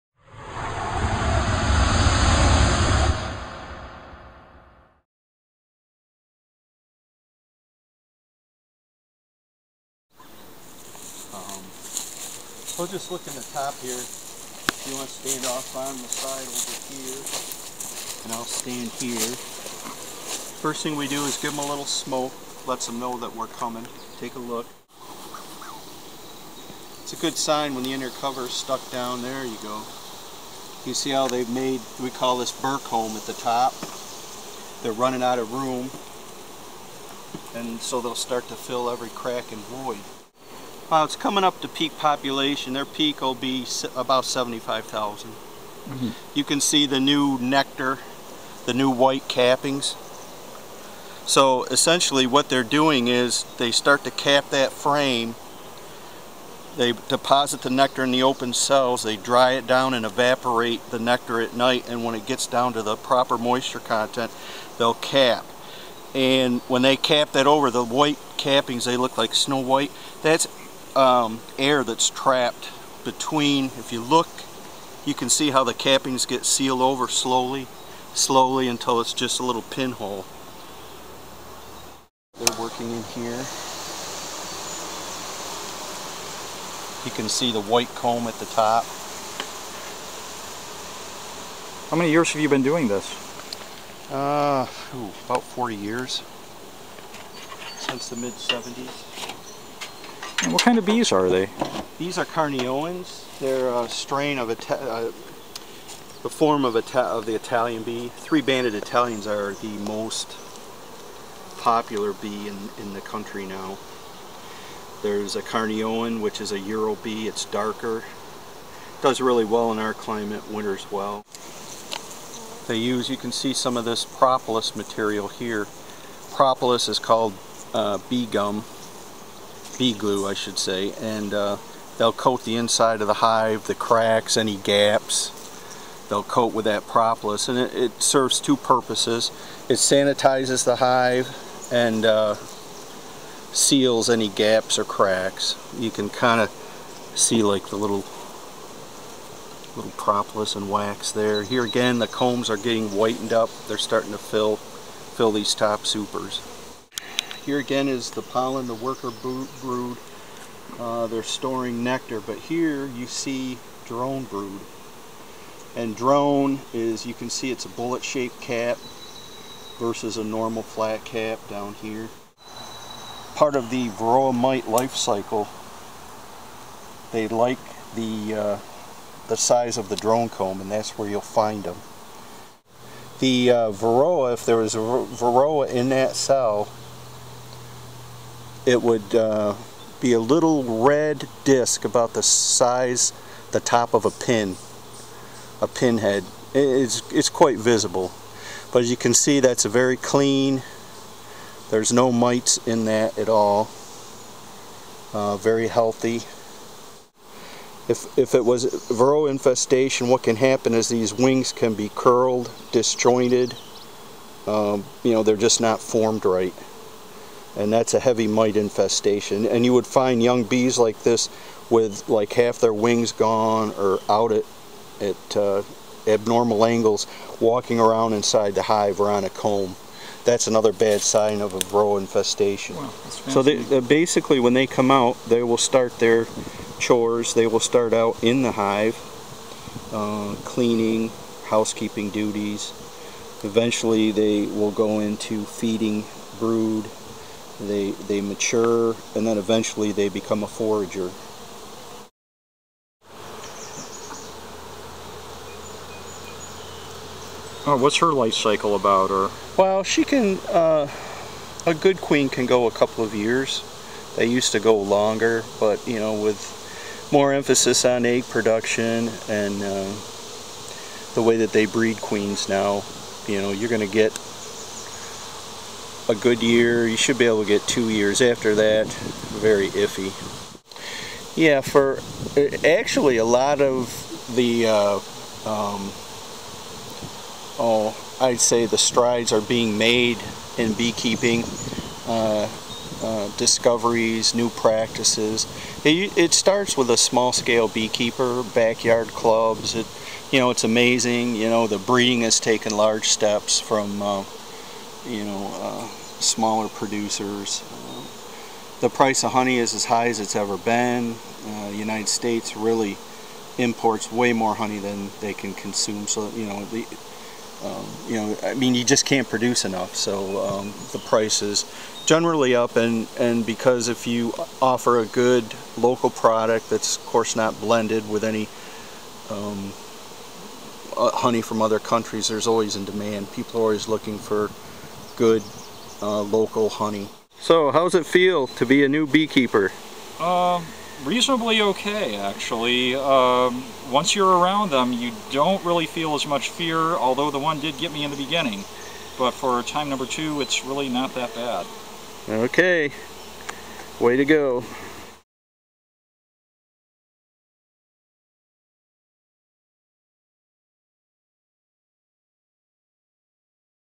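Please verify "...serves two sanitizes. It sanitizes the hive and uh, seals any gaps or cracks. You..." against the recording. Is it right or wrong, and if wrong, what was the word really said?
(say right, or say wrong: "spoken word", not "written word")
wrong: "purposes", not "sanitizes".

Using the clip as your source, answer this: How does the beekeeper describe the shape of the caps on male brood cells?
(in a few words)
bullet-shaped.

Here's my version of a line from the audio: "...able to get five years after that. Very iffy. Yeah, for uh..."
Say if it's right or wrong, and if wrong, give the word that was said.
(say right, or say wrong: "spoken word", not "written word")
wrong: "two", not "five".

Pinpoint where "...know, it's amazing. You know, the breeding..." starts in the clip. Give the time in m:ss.
5:00.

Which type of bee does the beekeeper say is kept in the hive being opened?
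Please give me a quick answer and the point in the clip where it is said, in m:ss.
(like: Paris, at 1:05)
Carniolans, at 1:42.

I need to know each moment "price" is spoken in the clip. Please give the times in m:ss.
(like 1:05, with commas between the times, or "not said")
5:08, 5:20.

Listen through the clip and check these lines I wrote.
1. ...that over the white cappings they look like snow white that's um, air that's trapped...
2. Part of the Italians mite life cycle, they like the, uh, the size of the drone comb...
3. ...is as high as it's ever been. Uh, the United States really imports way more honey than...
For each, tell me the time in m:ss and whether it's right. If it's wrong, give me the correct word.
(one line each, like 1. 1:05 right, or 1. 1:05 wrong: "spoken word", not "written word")
1. 1:07 right
2. 2:53 wrong: "Varroa", not "Italians"
3. 5:09 right.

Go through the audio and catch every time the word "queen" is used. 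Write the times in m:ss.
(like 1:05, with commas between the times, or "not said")
4:22, 4:31.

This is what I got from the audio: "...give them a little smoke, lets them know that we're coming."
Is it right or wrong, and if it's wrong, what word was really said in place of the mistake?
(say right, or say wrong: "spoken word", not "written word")
right.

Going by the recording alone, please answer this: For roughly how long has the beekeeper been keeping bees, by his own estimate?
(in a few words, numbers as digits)
about 40 years.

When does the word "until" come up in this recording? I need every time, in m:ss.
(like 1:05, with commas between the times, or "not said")
1:18.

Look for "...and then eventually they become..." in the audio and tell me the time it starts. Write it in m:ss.
4:09.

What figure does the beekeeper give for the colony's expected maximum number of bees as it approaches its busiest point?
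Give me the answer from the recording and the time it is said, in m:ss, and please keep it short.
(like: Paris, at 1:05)
75,000, at 0:44.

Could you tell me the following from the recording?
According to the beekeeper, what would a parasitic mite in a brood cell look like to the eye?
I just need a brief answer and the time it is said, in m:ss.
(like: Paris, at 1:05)
a little red disc, at 3:10.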